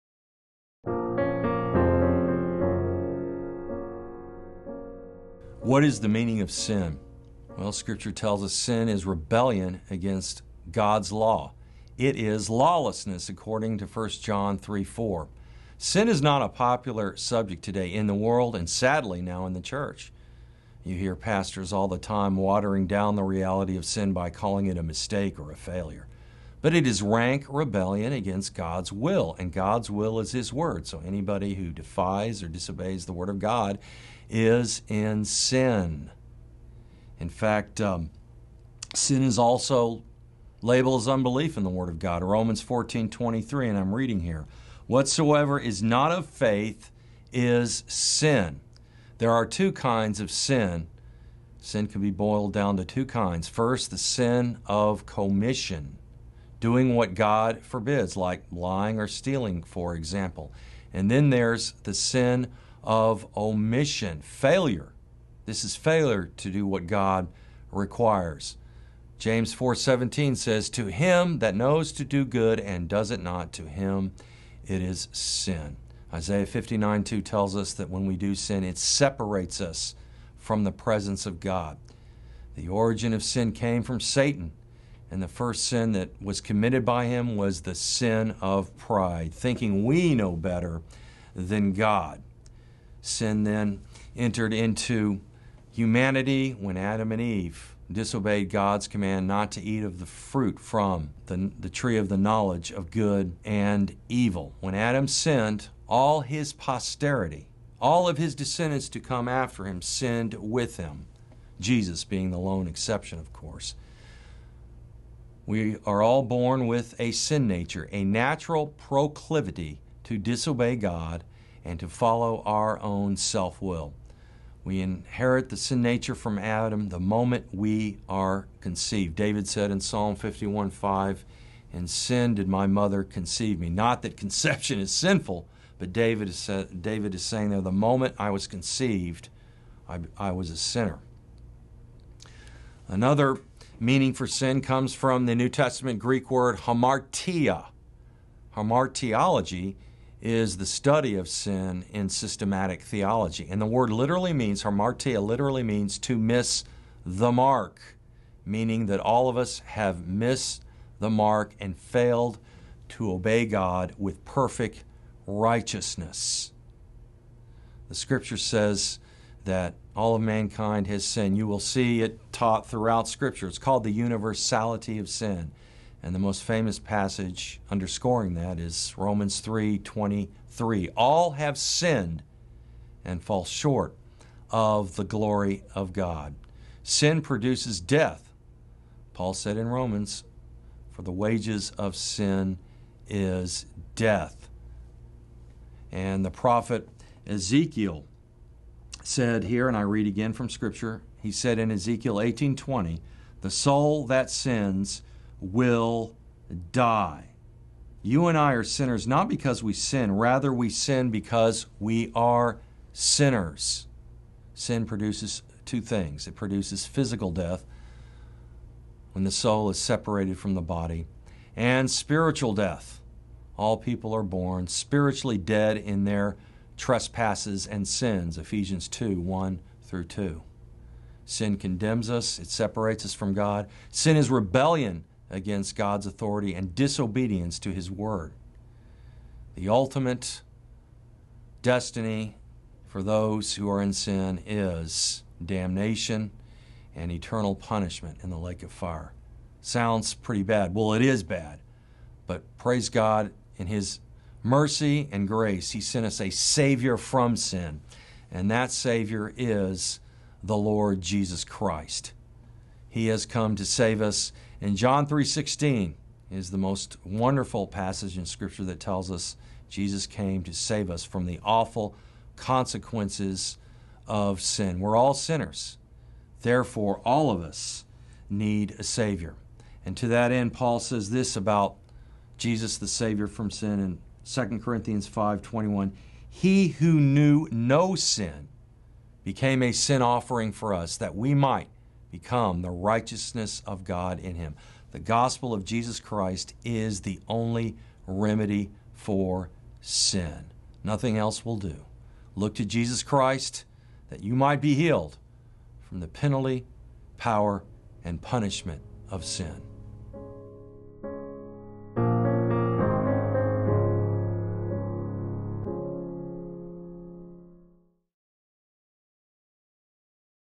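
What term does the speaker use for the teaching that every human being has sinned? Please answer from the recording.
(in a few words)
universality of sin.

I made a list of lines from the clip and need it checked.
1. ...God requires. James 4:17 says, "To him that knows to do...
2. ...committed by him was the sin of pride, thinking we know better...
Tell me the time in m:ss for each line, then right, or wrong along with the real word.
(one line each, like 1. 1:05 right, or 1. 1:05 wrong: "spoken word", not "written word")
1. 1:06 right
2. 1:26 right.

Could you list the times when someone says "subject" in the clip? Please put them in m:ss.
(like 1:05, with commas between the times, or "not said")
0:17.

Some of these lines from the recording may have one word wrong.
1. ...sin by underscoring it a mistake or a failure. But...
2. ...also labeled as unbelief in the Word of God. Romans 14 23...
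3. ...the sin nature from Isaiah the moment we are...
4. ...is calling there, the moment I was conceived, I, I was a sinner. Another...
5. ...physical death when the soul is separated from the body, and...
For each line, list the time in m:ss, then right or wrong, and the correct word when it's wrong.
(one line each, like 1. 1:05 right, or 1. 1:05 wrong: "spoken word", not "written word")
1. 0:23 wrong: "calling", not "underscoring"
2. 0:39 right
3. 2:05 wrong: "Adam", not "Isaiah"
4. 2:17 wrong: "saying", not "calling"
5. 3:36 right.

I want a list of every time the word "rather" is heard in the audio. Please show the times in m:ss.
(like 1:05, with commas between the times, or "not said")
3:30.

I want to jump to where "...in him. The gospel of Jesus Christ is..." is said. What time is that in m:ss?
4:54.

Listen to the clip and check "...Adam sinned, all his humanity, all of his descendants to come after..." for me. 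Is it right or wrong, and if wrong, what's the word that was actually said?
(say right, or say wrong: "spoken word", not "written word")
wrong: "posterity", not "humanity".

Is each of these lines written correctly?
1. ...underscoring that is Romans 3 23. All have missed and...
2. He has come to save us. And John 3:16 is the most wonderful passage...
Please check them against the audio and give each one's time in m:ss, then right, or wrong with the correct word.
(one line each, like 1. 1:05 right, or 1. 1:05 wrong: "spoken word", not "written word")
1. 2:57 wrong: "sinned", not "missed"
2. 4:22 right.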